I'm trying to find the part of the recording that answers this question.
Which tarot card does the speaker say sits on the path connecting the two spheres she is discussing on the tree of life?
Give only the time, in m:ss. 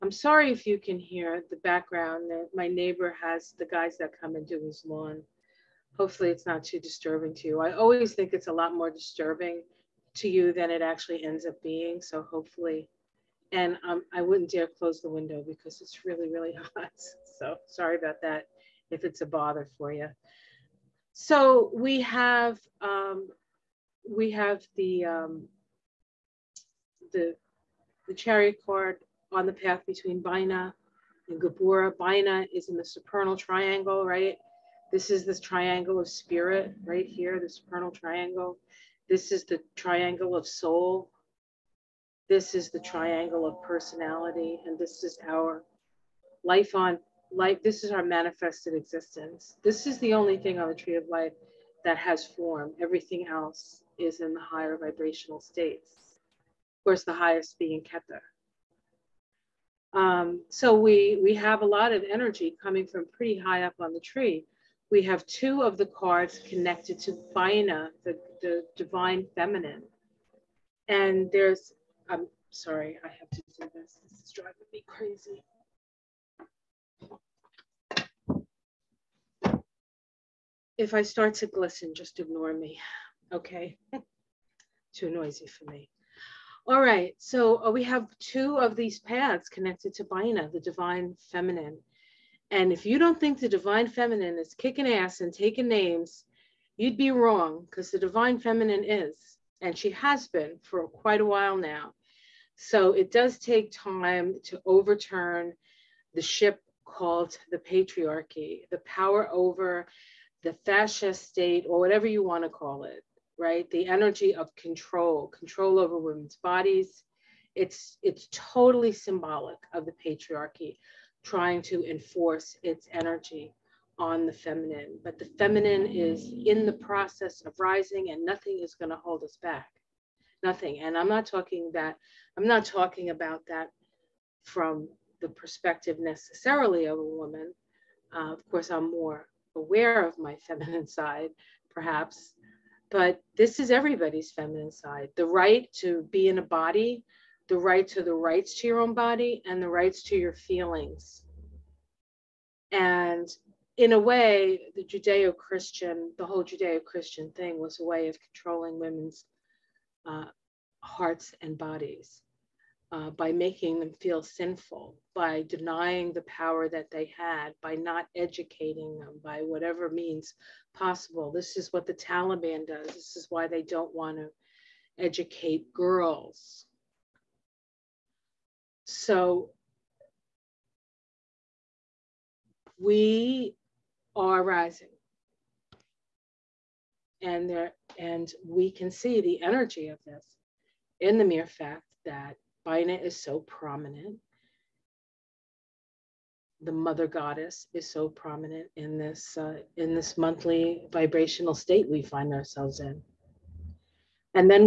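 0:28.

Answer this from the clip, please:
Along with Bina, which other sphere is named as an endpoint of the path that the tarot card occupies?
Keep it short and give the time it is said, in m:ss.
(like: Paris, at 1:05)
Geburah, at 0:31.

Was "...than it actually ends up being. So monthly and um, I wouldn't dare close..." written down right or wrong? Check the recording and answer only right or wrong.
wrong.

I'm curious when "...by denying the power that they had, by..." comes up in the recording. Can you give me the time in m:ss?
2:45.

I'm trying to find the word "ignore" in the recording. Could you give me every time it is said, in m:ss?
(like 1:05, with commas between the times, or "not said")
1:22.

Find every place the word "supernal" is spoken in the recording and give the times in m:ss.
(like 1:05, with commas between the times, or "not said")
0:32, 0:37.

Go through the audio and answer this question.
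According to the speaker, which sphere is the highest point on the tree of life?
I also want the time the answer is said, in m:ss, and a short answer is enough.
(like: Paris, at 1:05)
Keter, at 0:57.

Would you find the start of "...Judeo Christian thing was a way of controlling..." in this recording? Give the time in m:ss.
2:36.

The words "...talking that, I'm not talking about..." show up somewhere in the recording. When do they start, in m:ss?
2:11.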